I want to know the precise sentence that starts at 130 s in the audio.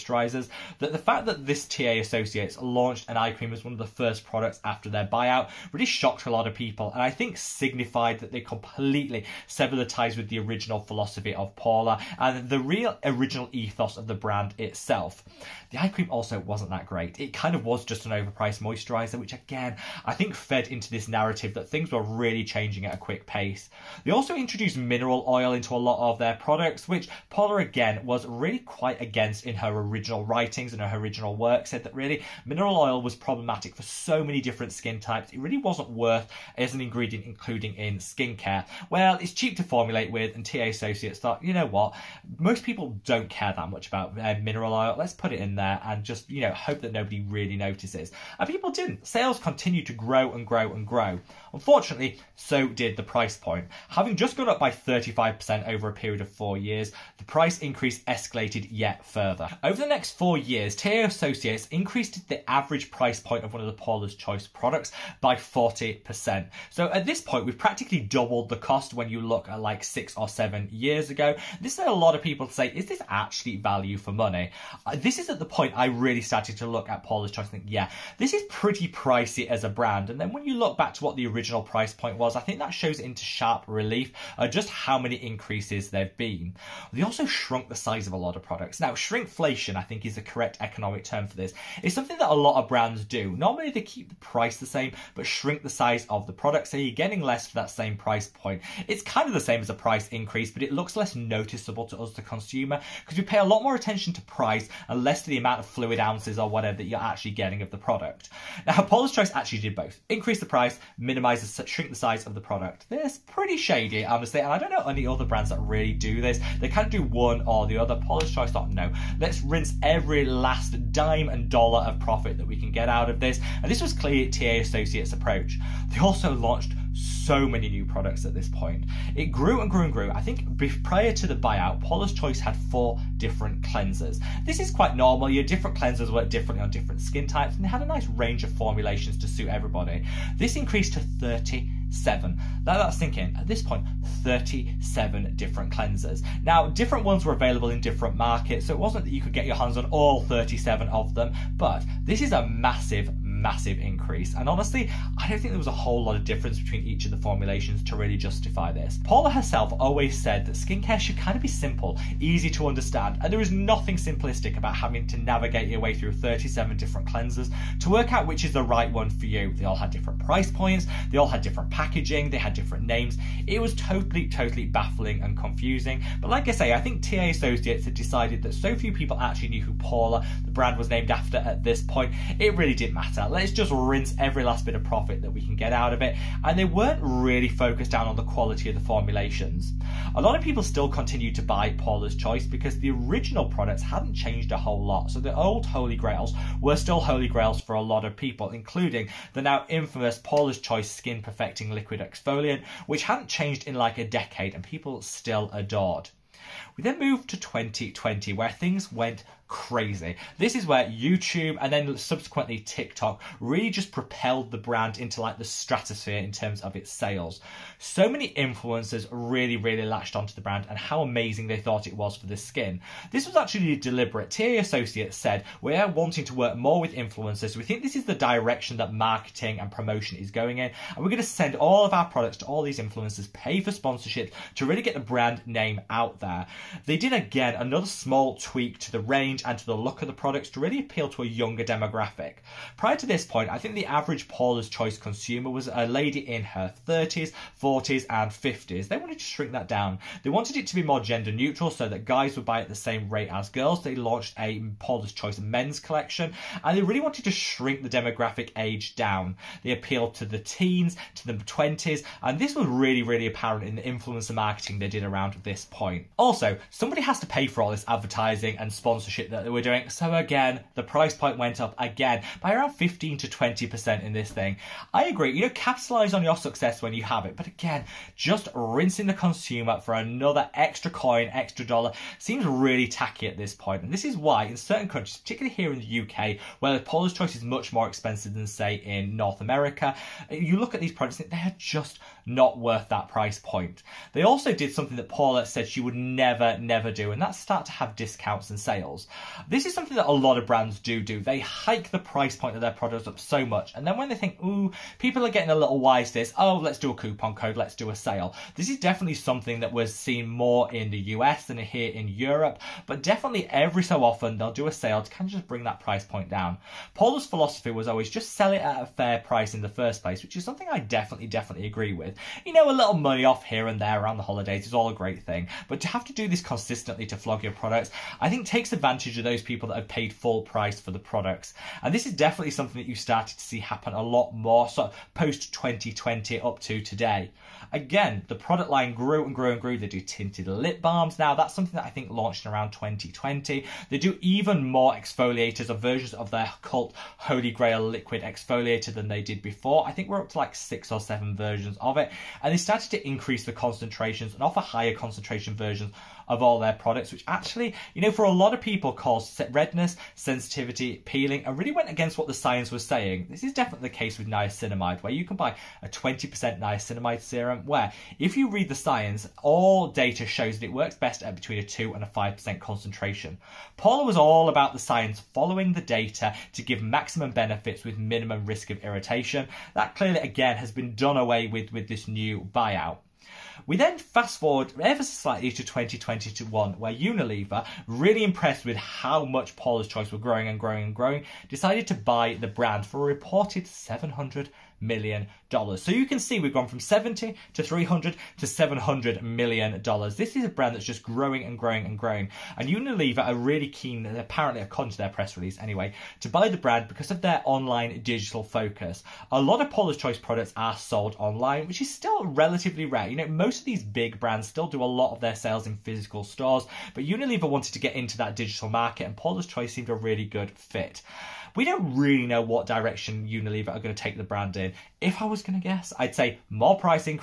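I think prior to the buyout, Paula's Choice had four different cleansers.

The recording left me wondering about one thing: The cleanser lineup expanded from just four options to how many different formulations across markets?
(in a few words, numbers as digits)
37.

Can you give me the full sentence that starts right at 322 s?
You know, a little money off here and there around the holidays is all a great thing.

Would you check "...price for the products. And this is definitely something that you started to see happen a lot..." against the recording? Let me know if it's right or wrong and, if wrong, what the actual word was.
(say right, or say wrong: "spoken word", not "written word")
right.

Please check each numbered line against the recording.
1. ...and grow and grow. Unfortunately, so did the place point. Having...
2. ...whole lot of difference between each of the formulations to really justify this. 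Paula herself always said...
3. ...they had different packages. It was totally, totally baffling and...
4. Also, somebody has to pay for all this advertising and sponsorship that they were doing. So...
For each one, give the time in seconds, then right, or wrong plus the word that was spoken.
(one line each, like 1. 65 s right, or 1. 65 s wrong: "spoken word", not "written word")
1. 50 s wrong: "price", not "place"
2. 155 s right
3. 172 s wrong: "names", not "packages"
4. 266 s right.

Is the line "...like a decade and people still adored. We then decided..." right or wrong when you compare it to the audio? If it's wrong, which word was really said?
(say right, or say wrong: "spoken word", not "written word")
wrong: "moved", not "decided".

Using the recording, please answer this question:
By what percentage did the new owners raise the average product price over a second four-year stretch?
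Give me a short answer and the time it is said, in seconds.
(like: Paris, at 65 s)
40%, at 65 s.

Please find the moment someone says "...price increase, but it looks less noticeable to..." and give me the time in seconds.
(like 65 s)
99 s.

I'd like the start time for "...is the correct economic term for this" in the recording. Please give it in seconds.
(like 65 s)
90 s.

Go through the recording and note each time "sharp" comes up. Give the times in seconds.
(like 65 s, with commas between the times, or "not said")
83 s.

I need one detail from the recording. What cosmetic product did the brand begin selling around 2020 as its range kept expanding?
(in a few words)
tinted lip balms.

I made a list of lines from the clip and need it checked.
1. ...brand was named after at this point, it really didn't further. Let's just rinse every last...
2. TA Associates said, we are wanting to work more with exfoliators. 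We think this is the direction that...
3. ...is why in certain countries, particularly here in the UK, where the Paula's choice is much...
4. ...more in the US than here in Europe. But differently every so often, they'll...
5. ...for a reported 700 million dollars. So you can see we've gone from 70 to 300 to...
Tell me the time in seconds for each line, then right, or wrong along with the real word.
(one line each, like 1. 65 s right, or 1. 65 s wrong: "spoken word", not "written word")
1. 180 s wrong: "matter", not "further"
2. 224 s wrong: "influencers", not "exfoliators"
3. 284 s right
4. 310 s wrong: "definitely", not "differently"
5. 392 s right.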